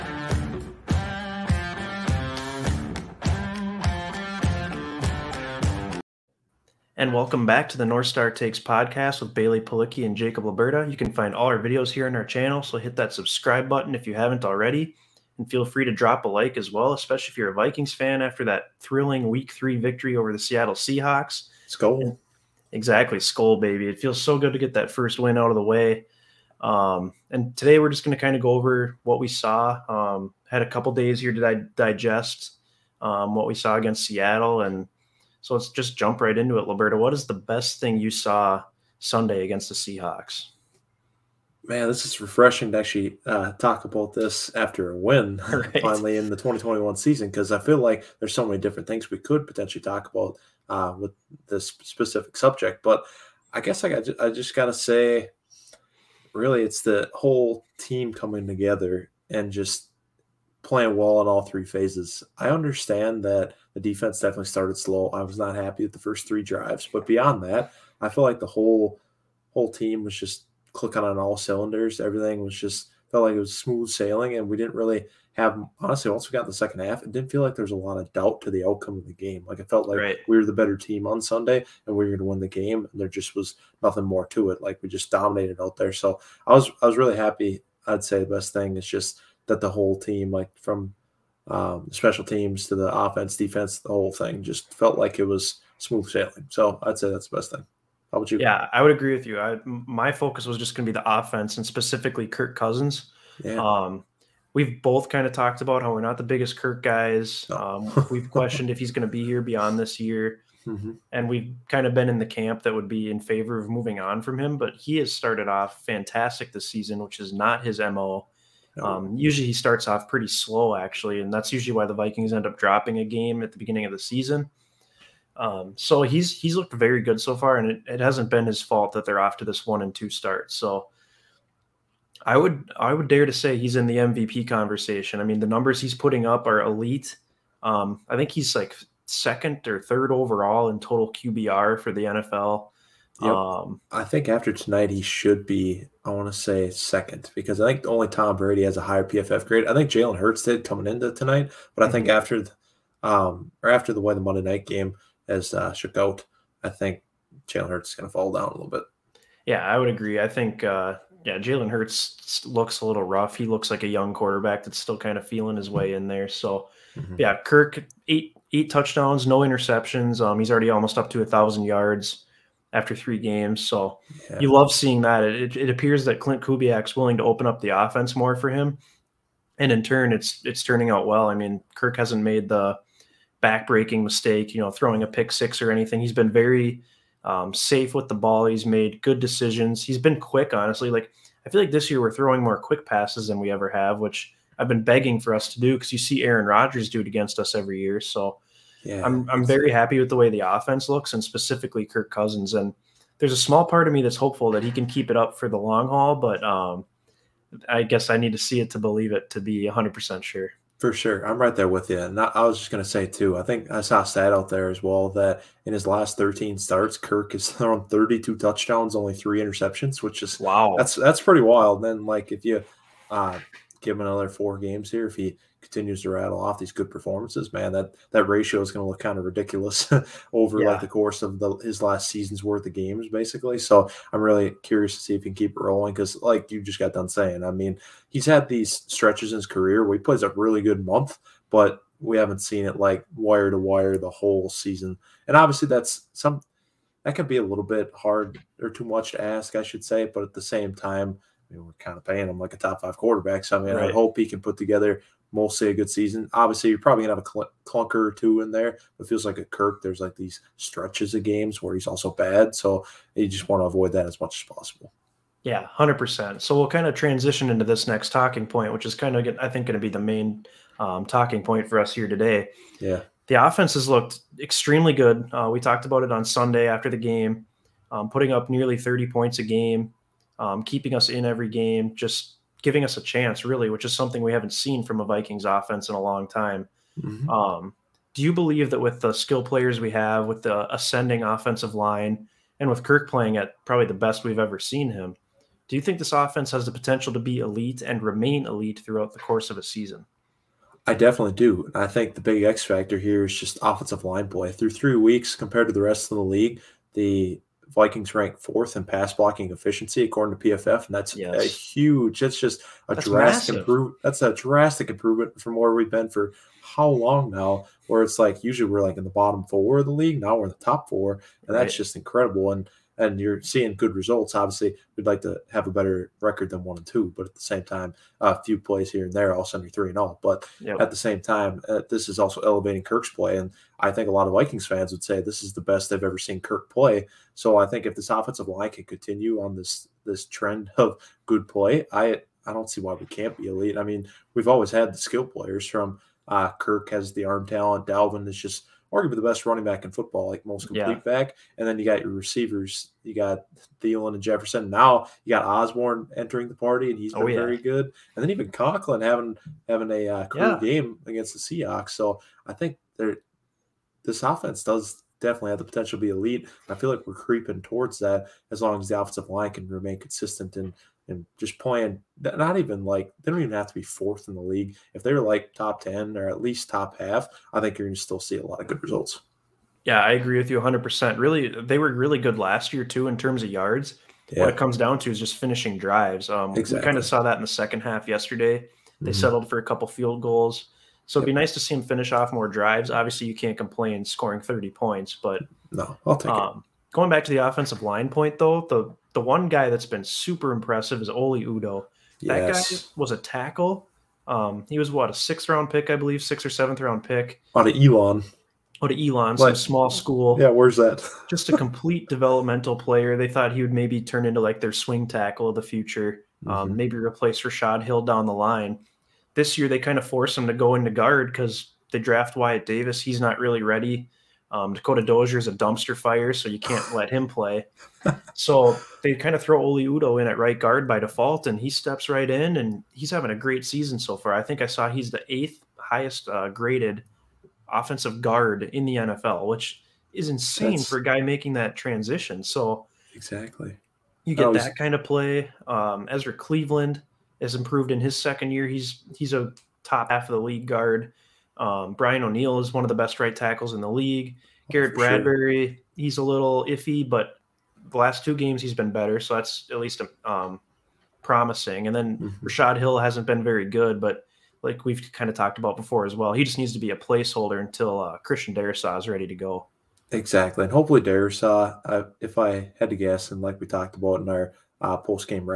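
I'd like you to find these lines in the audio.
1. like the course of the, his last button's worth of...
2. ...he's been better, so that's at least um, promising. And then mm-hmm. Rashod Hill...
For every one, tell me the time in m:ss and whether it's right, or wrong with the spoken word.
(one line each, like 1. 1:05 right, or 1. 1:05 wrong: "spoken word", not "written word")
1. 3:50 wrong: "season", not "button"
2. 7:38 right.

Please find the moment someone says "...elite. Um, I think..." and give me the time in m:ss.
2:16.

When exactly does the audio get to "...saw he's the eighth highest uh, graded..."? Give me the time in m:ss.
7:14.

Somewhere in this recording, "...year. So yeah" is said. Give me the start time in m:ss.
3:17.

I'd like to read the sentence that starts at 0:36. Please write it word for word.
What is the best thing you saw Sunday against the Seahawks?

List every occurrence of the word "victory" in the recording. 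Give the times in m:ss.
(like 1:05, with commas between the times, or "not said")
0:19.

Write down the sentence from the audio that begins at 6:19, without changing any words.
Yeah, I agree with you 100%.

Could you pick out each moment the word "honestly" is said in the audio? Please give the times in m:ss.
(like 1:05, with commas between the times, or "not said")
1:15, 3:10.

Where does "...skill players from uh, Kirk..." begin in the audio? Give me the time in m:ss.
5:44.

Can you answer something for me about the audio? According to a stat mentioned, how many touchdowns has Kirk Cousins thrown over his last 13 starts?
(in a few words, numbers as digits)
32.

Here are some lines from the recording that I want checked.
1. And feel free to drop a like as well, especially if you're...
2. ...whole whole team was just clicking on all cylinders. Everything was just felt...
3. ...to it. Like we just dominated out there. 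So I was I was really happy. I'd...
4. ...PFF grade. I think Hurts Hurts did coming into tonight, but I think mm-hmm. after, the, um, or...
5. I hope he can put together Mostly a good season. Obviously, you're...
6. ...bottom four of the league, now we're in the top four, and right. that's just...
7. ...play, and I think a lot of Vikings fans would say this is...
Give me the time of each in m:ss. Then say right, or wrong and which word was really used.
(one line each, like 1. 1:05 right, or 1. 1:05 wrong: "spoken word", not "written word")
1. 0:15 right
2. 1:08 right
3. 1:24 right
4. 2:29 wrong: "Jalen", not "Hurts"
5. 4:13 right
6. 5:19 right
7. 5:33 right.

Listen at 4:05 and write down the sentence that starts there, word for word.
And obviously, that's some that can be a little bit hard or too much to ask, I should say.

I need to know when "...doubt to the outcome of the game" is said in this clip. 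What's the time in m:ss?
1:18.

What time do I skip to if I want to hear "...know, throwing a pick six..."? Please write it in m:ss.
3:04.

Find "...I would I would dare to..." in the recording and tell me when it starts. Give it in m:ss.
2:12.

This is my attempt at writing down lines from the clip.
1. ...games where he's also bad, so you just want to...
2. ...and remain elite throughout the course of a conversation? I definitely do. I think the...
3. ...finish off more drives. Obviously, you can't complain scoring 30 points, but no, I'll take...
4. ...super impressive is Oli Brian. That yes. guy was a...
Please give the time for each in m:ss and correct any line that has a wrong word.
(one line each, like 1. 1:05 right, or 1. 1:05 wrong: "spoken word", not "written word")
1. 4:21 right
2. 4:57 wrong: "season", not "conversation"
3. 6:31 right
4. 6:40 wrong: "Udoh", not "Brian".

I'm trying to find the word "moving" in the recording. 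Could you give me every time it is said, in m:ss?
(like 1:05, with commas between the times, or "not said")
1:53.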